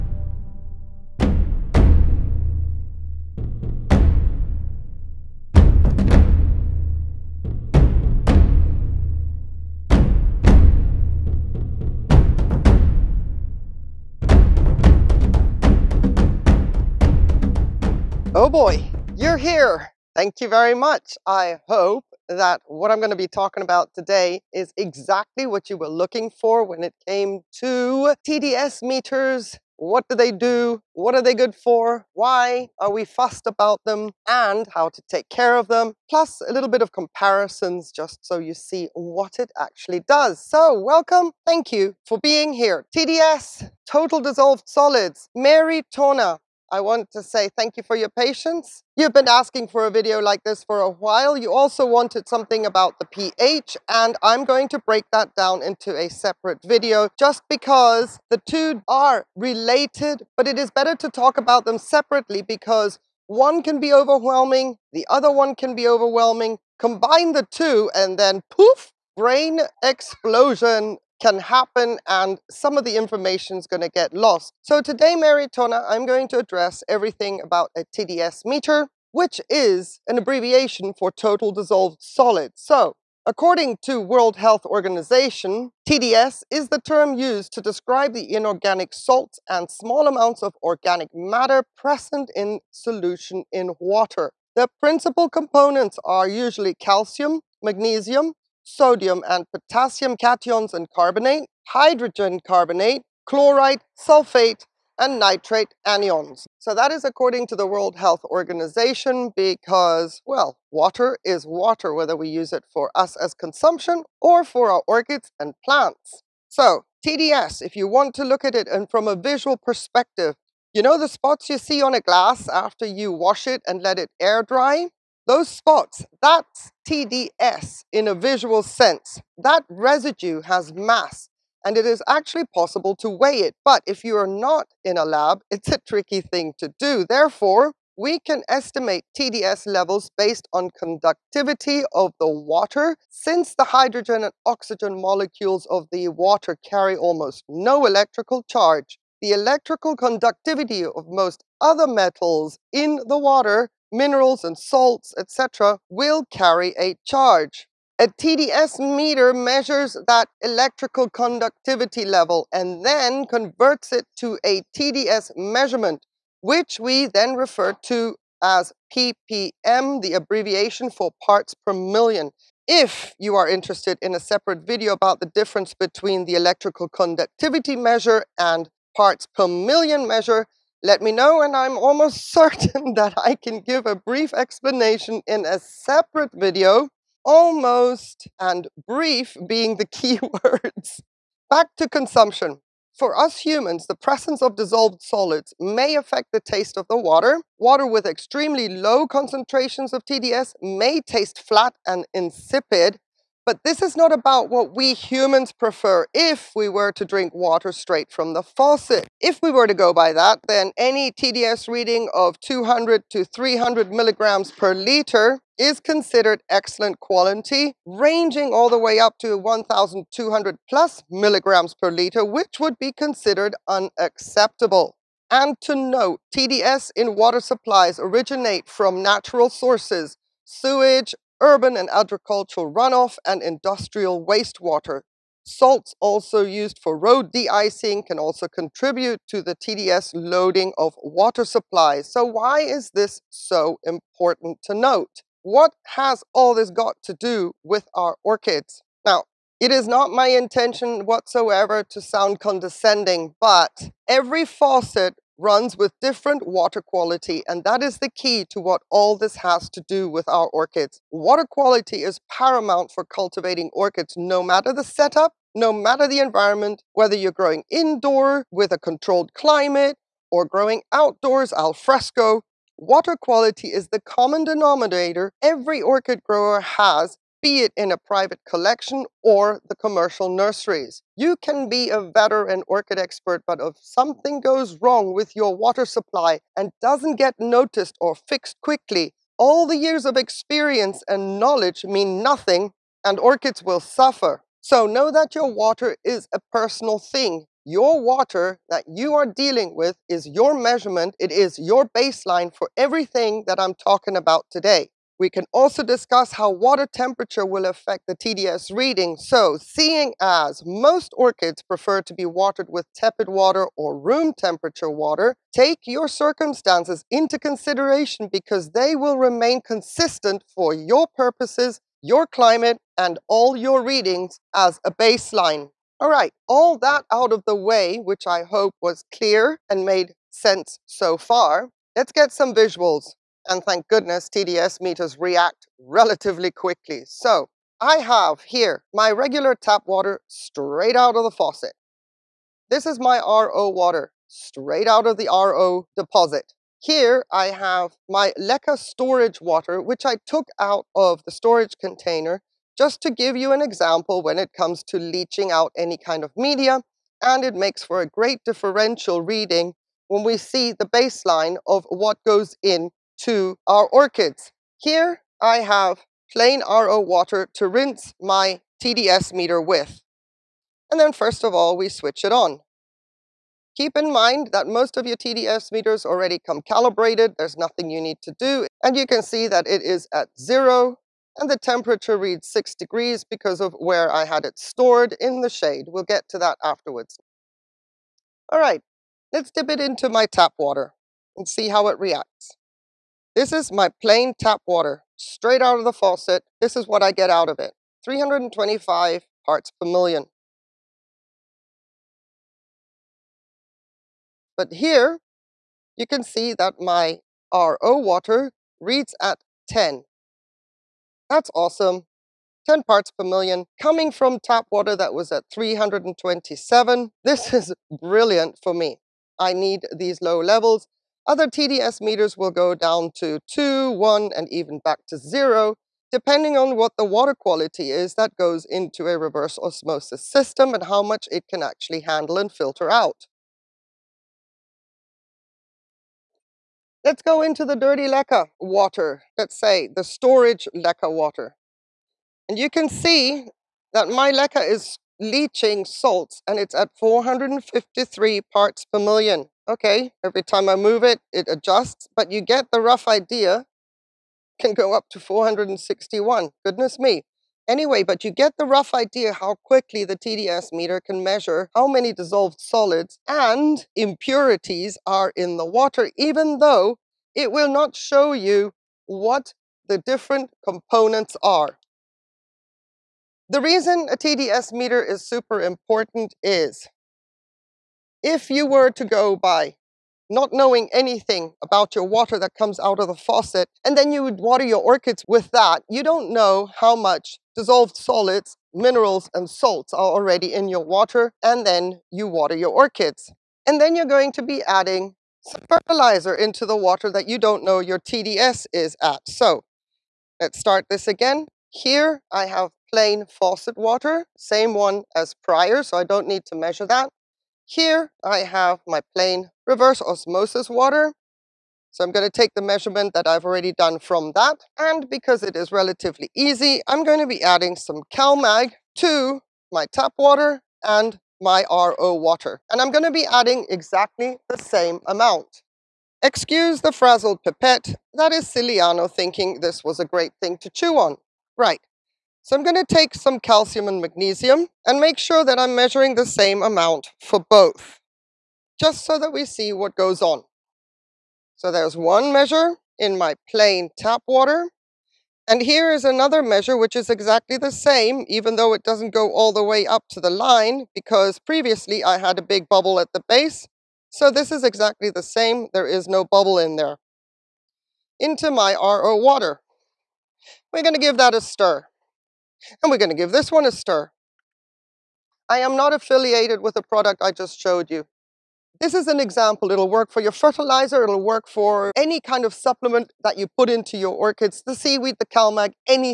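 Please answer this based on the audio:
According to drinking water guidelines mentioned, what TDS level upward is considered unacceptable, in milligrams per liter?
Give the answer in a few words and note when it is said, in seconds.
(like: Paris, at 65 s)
1,200, at 219 s.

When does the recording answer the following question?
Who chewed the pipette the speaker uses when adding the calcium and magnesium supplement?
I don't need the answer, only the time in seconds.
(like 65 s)
528 s.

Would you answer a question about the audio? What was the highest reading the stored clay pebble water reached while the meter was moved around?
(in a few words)
461.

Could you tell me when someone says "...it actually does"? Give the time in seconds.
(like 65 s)
39 s.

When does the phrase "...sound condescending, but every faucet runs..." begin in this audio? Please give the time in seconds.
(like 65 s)
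252 s.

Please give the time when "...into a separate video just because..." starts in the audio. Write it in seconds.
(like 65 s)
55 s.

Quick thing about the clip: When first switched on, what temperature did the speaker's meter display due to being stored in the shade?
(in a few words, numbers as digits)
6 degrees.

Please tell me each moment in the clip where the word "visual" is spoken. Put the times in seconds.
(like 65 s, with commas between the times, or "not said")
119 s, 128 s, 332 s.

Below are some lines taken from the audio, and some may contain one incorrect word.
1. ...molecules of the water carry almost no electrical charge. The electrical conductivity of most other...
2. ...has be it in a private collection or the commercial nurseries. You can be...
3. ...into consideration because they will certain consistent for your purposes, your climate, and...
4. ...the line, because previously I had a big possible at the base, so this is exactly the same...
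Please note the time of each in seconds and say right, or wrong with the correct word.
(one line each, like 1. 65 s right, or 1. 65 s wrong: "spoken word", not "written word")
1. 144 s right
2. 276 s right
3. 317 s wrong: "remain", not "certain"
4. 550 s wrong: "bubble", not "possible".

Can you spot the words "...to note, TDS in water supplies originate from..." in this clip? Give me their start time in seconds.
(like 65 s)
225 s.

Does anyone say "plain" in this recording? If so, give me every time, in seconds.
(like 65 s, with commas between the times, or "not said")
366 s, 394 s, 502 s, 509 s, 543 s.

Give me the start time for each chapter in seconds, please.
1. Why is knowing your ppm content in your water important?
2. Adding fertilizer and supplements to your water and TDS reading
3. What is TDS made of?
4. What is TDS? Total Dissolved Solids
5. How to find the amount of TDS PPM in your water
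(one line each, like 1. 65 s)
1. 472 s
2. 499 s
3. 225 s
4. 76 s
5. 338 s.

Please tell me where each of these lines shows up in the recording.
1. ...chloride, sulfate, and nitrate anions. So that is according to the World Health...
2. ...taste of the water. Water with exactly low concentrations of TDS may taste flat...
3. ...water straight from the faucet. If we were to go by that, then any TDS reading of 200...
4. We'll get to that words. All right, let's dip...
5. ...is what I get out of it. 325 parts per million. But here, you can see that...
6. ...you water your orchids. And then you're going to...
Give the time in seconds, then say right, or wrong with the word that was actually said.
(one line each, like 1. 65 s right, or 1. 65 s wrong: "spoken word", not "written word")
1. 103 s right
2. 196 s wrong: "extremely", not "exactly"
3. 207 s right
4. 385 s wrong: "afterwards", not "words"
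5. 396 s right
6. 492 s right.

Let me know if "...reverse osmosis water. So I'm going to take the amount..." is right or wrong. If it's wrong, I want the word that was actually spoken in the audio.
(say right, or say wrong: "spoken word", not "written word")
wrong: "measurement", not "amount".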